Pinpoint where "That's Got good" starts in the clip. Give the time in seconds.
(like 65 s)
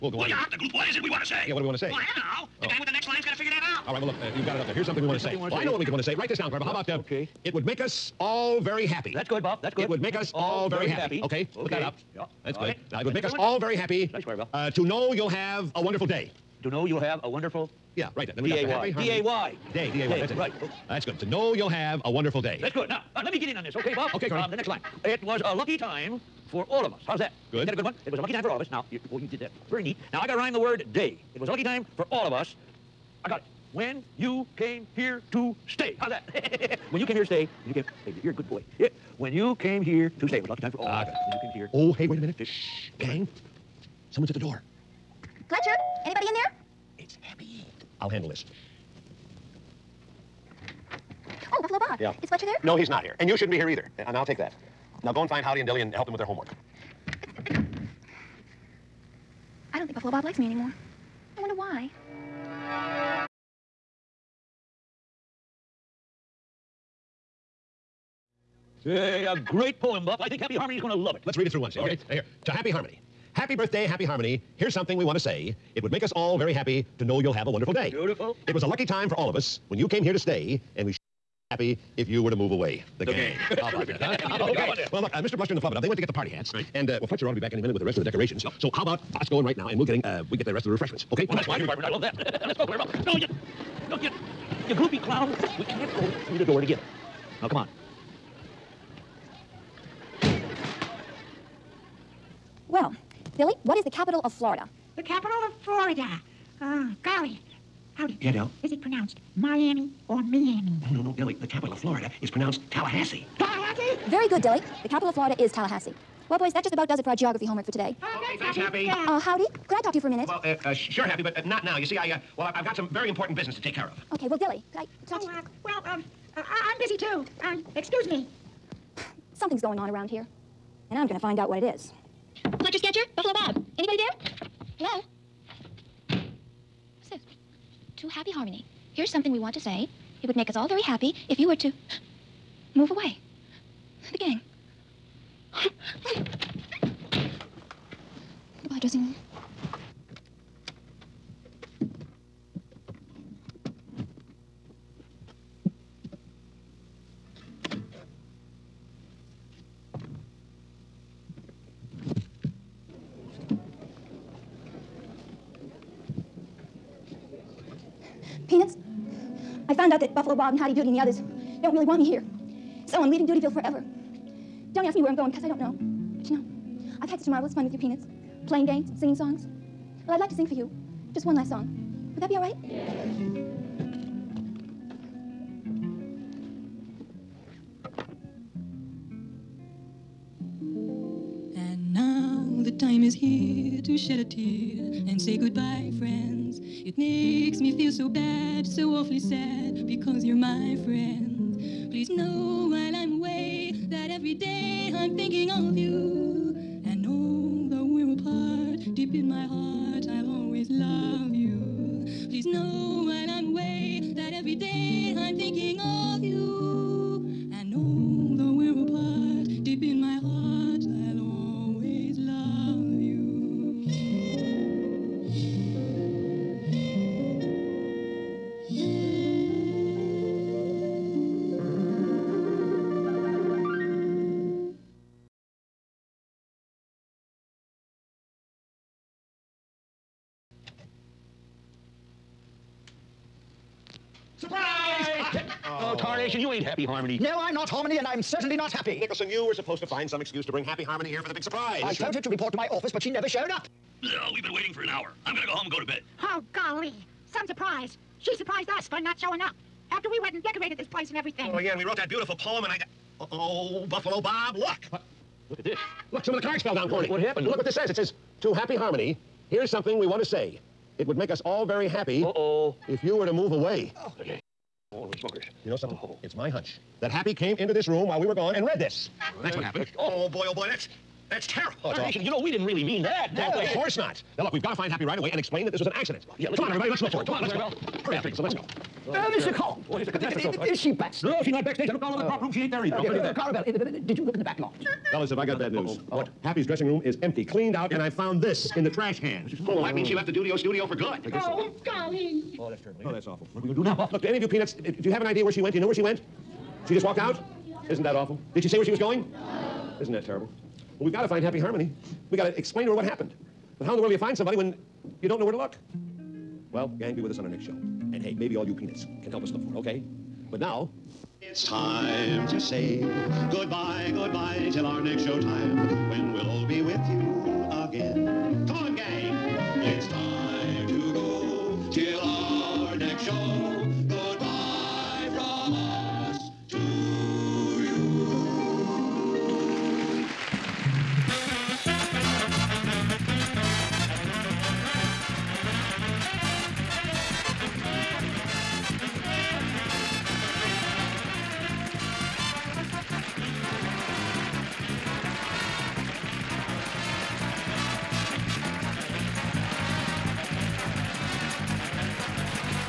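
12 s.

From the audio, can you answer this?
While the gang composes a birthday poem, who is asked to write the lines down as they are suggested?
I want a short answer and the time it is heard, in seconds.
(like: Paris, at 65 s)
Clara, at 6 s.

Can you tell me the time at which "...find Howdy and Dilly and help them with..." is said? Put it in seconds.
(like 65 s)
55 s.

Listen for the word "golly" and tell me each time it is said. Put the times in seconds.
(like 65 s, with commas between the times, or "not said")
107 s, 256 s, 301 s.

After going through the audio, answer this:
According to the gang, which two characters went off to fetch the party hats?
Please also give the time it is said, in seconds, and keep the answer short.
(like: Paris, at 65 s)
Mr. Bluster and the Flubadub, at 85 s.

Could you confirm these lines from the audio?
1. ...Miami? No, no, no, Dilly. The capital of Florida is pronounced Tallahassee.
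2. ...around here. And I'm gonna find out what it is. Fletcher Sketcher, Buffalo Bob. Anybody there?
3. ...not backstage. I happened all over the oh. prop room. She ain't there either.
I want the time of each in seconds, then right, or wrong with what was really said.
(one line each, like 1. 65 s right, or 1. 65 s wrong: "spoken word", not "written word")
1. 110 s right
2. 129 s right
3. 291 s wrong: "looked", not "happened".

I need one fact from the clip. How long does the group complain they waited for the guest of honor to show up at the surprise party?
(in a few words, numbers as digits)
an hour.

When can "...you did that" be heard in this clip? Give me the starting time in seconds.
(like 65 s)
29 s.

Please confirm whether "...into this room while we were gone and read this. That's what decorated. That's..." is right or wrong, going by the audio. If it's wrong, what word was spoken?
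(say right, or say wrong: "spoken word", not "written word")
wrong: "happened", not "decorated".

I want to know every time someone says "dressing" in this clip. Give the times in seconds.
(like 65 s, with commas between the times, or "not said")
148 s, 296 s.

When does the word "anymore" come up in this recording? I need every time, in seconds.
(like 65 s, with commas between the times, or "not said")
60 s.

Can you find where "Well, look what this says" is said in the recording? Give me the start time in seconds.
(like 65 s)
267 s.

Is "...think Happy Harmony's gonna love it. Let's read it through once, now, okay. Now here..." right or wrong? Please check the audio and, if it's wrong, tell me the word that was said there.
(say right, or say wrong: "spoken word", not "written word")
right.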